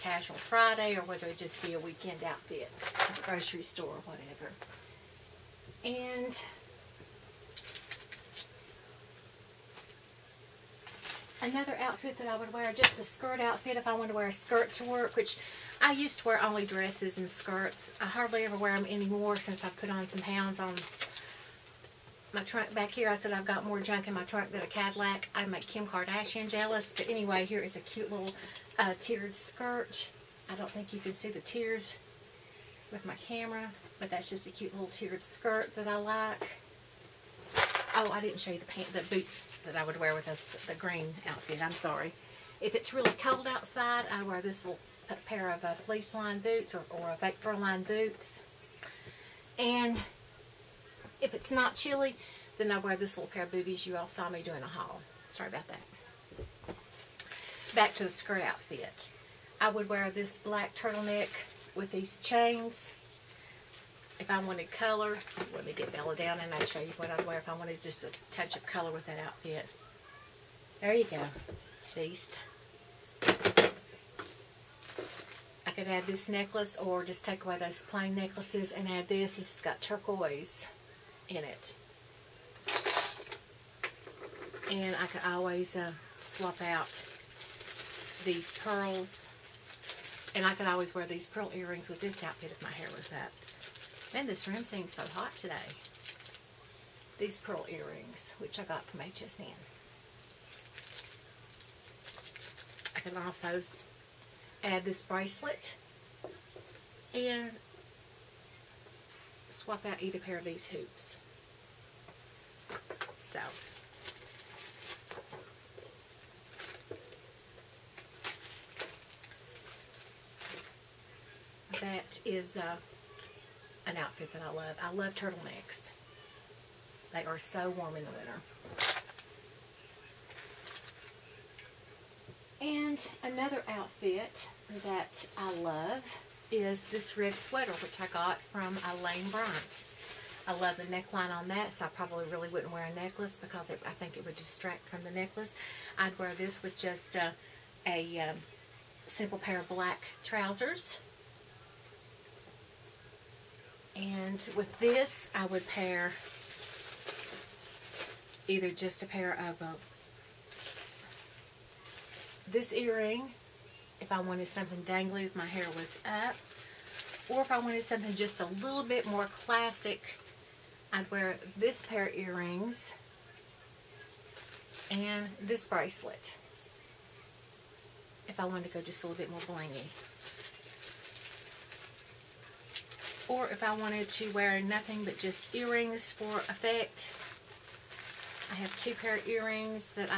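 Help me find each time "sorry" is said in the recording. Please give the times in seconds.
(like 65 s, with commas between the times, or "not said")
41 s, 55 s.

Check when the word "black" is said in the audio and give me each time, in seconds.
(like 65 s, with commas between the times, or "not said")
60 s, 149 s.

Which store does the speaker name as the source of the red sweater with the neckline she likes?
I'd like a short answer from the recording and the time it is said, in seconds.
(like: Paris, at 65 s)
Lane Bryant, at 139 s.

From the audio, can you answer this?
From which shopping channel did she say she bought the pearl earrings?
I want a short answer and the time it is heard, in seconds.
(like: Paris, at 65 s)
HSN, at 98 s.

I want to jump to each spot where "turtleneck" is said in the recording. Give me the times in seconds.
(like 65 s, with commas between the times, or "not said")
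60 s, 125 s.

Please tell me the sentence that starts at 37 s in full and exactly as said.
Oh, I didn't show you the pant, the boots that I would wear with this, the, green outfit.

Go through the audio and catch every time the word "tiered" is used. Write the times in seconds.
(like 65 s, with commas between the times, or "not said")
28 s, 34 s.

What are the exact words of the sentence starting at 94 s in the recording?
Man, this room seems so hot today.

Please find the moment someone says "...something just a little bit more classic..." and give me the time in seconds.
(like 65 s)
167 s.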